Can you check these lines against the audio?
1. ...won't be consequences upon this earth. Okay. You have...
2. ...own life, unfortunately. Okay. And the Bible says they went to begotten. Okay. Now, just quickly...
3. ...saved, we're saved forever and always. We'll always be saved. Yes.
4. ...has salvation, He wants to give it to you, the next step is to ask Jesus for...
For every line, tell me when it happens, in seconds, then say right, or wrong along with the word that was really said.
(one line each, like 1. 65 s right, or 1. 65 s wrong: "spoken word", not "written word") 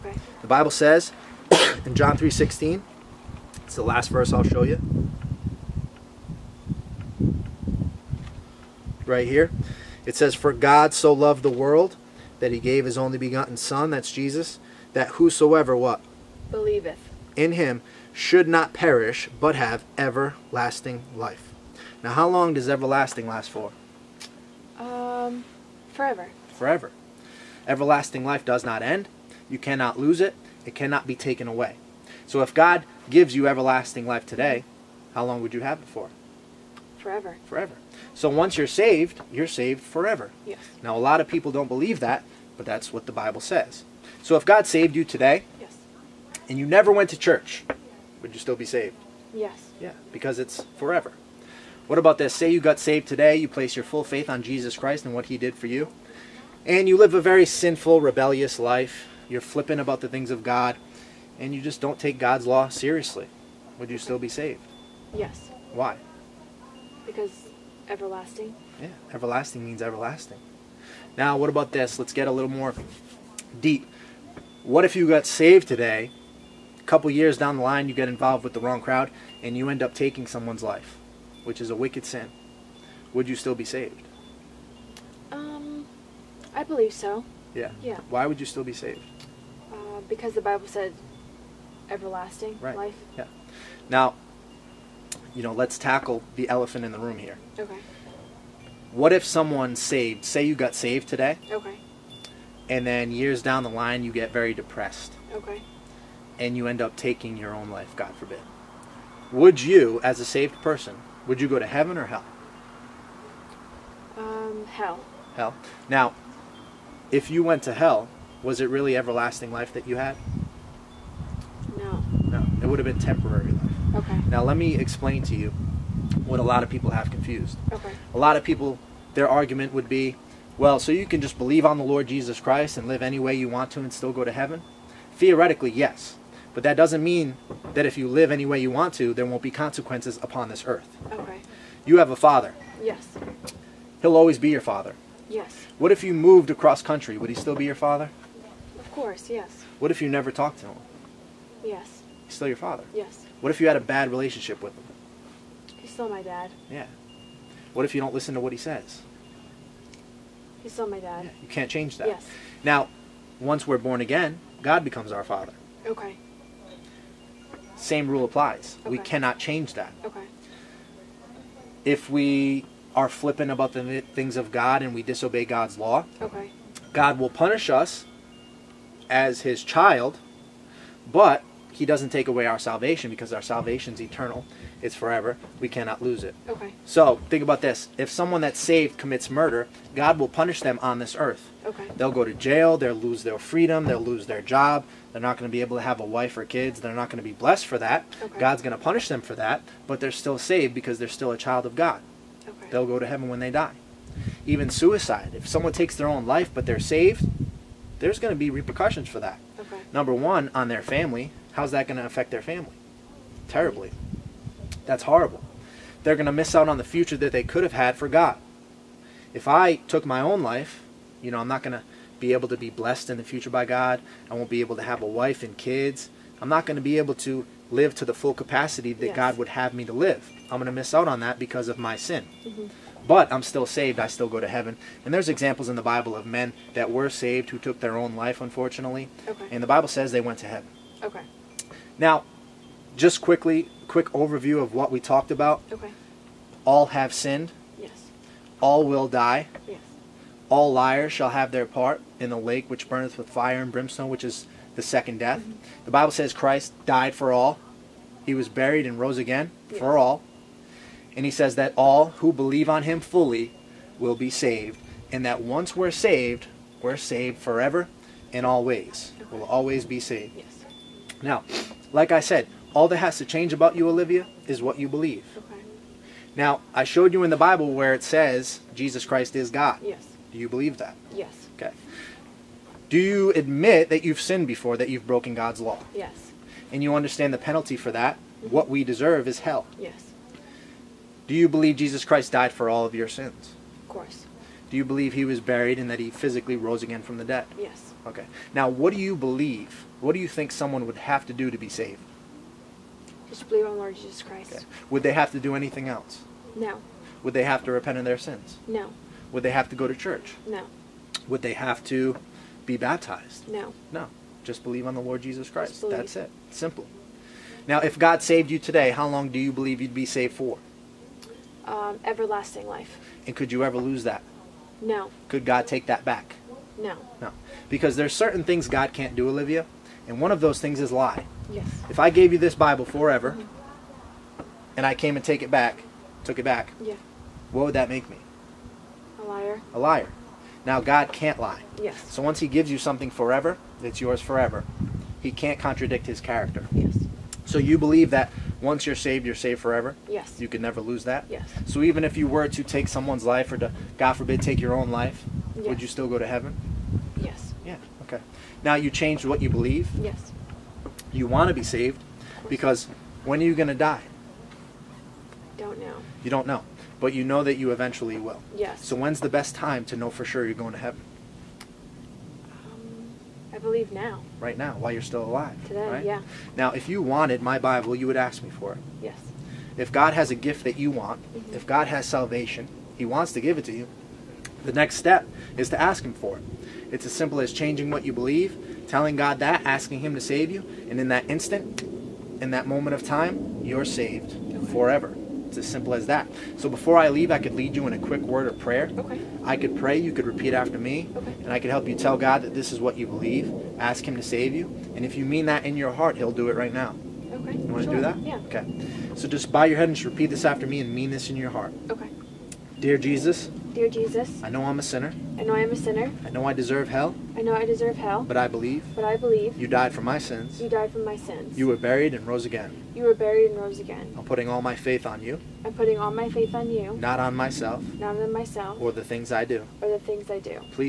1. 139 s right
2. 237 s wrong: "heaven", not "begotten"
3. 265 s right
4. 381 s wrong: "Him", not "Jesus".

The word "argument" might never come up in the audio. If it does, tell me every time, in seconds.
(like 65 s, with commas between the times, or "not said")
129 s.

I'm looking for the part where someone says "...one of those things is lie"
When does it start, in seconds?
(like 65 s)
330 s.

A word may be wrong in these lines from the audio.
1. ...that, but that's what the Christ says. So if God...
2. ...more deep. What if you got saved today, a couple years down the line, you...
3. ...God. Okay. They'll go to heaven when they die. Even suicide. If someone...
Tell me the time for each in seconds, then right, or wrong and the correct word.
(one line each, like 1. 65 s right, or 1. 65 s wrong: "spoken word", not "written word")
1. 41 s wrong: "Bible", not "Christ"
2. 72 s right
3. 201 s right.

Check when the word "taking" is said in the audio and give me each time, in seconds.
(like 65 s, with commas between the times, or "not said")
79 s, 106 s.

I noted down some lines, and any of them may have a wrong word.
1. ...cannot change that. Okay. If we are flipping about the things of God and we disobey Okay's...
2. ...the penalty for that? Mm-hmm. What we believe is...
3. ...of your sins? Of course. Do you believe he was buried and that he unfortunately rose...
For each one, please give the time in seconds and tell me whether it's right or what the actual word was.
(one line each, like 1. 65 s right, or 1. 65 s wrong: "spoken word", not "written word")
1. 168 s wrong: "God", not "Okay"
2. 287 s wrong: "deserve", not "believe"
3. 292 s wrong: "physically", not "unfortunately".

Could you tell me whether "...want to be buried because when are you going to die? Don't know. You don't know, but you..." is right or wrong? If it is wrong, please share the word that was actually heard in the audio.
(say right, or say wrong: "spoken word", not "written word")
wrong: "saved", not "buried".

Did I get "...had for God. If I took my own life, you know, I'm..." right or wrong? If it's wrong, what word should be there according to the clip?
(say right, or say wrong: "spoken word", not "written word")
right.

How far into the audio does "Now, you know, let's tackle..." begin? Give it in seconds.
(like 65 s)
93 s.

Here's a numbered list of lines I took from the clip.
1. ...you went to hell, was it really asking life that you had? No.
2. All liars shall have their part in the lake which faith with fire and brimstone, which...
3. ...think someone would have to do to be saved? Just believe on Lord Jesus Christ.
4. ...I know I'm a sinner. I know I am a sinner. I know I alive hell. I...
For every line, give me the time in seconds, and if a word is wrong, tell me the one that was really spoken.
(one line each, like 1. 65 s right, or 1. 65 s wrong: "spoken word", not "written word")
1. 117 s wrong: "everlasting", not "asking"
2. 250 s wrong: "burneth", not "faith"
3. 300 s right
4. 414 s wrong: "deserve", not "alive".